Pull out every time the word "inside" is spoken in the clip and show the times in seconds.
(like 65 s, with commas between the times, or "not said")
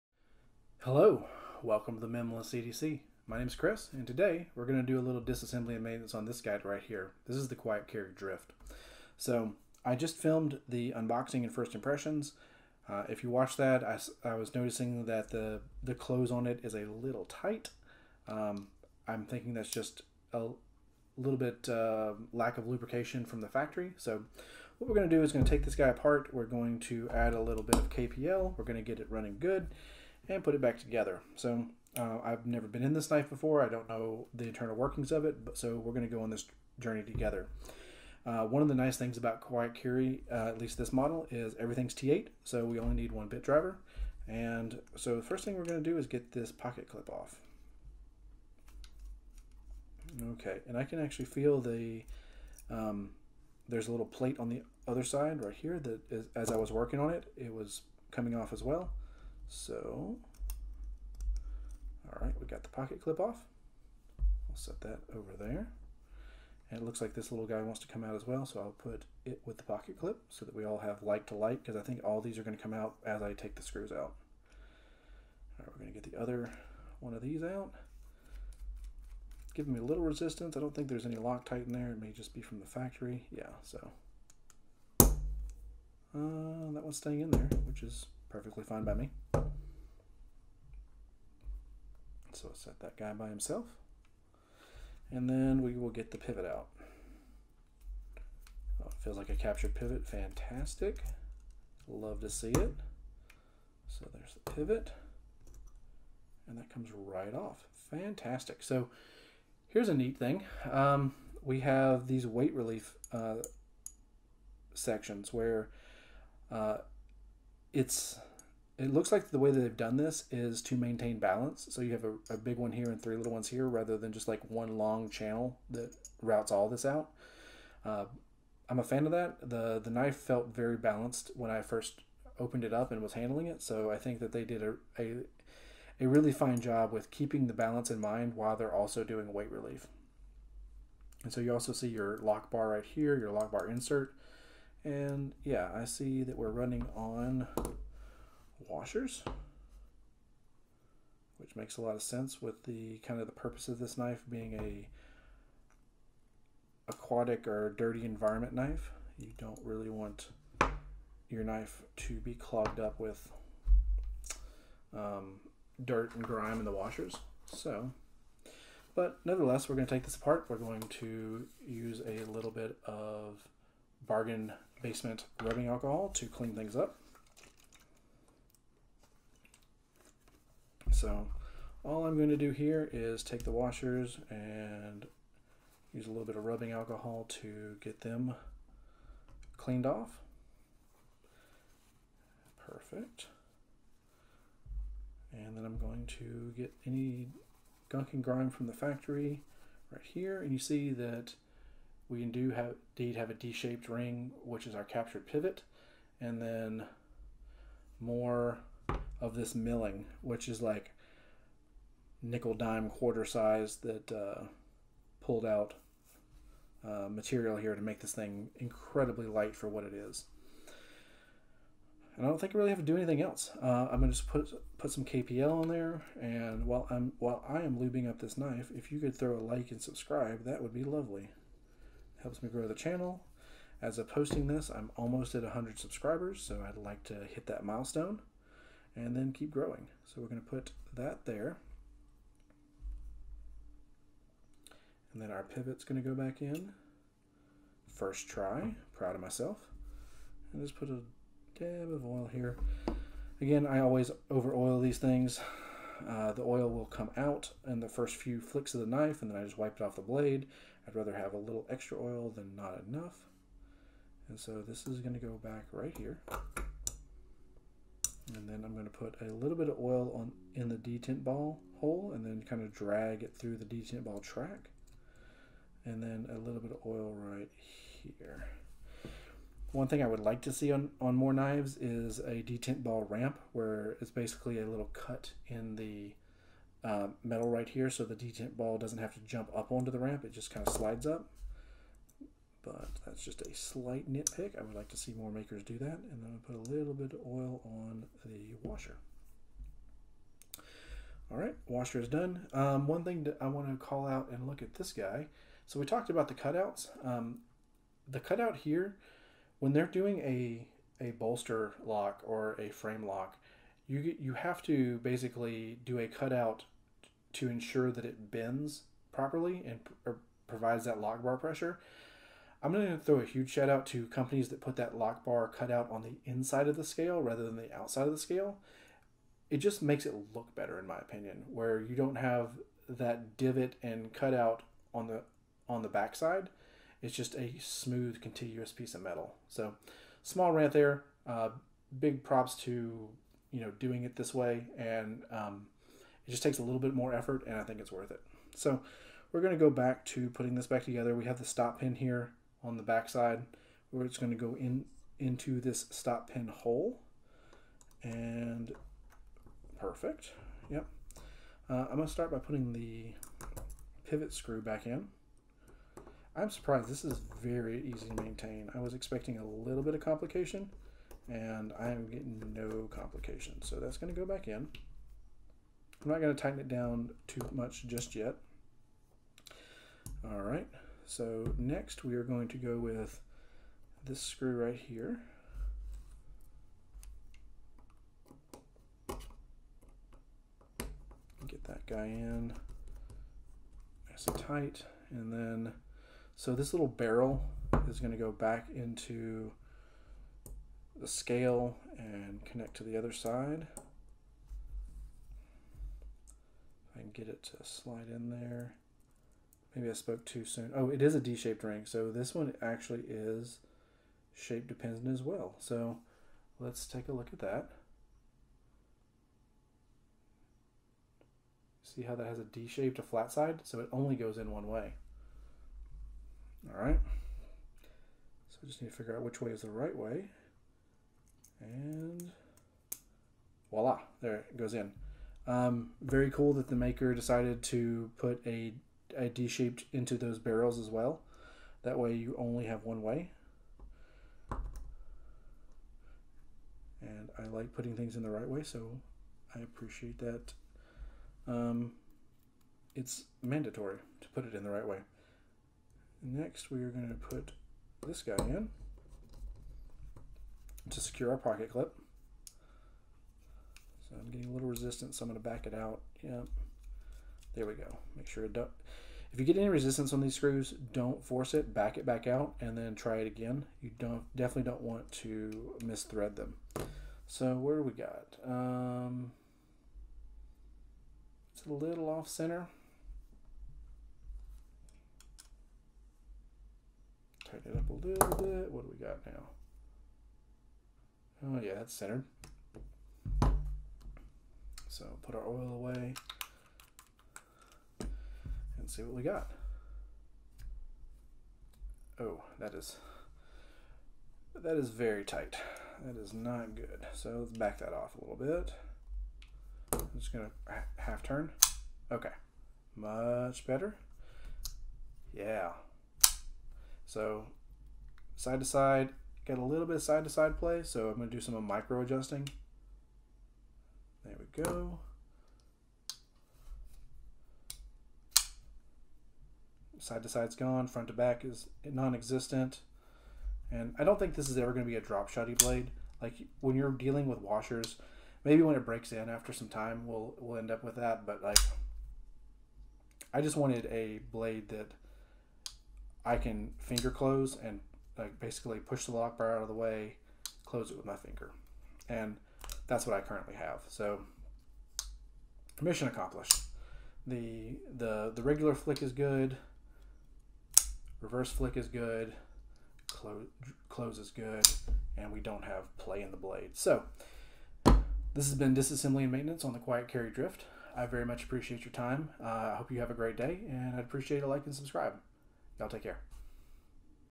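326 s.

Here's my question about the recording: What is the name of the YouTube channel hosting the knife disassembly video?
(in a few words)
Minimalist EDC.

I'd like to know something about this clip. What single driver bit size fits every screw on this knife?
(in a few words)
T8.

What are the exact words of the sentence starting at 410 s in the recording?
Oh, it is a D-shaped ring.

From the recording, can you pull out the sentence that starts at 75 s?
All right, we're going to get the other one of these out.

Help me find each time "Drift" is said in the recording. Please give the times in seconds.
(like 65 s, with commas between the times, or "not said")
8 s, 570 s.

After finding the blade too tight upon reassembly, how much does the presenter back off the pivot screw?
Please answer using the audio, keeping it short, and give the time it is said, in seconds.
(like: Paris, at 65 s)
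half turn, at 510 s.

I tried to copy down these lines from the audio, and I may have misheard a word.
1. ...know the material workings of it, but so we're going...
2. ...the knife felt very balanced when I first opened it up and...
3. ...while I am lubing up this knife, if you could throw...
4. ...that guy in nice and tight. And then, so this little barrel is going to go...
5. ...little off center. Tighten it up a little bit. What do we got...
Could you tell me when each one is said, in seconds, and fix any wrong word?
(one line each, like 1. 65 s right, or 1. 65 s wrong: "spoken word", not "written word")
1. 33 s wrong: "internal", not "material"
2. 129 s right
3. 227 s right
4. 391 s right
5. 481 s right.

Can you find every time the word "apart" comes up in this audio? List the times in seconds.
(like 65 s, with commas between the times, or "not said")
25 s, 170 s.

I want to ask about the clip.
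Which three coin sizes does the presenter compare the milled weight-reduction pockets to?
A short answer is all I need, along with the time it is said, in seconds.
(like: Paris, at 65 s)
nickel, dime, quarter, at 212 s.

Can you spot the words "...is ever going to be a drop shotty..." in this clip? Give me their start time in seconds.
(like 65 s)
534 s.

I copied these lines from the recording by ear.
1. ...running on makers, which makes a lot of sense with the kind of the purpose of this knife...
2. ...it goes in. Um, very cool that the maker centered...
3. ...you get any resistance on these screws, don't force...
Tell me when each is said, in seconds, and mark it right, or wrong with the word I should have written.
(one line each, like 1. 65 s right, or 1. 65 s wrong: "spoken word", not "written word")
1. 146 s wrong: "washers", not "makers"
2. 434 s wrong: "decided", not "centered"
3. 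469 s right.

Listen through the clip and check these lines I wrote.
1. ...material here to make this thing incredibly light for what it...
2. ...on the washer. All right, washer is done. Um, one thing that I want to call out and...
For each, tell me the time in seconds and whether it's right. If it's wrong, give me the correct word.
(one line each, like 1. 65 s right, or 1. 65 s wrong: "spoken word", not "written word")
1. 217 s right
2. 297 s right.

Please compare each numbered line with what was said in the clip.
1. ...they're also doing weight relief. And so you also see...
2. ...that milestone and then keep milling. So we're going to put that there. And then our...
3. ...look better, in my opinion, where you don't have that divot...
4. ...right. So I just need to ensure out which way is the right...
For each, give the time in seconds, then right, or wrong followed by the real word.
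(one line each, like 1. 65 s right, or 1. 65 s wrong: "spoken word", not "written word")
1. 138 s right
2. 237 s wrong: "growing", not "milling"
3. 330 s right
4. 426 s wrong: "figure", not "ensure".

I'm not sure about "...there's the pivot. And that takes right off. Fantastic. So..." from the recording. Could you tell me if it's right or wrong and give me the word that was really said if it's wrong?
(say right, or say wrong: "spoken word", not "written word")
wrong: "comes", not "takes".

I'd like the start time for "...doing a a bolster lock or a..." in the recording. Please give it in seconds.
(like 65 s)
309 s.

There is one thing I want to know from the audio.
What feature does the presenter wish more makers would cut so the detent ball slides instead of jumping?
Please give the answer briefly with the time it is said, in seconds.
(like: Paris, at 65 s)
detent ball ramp, at 282 s.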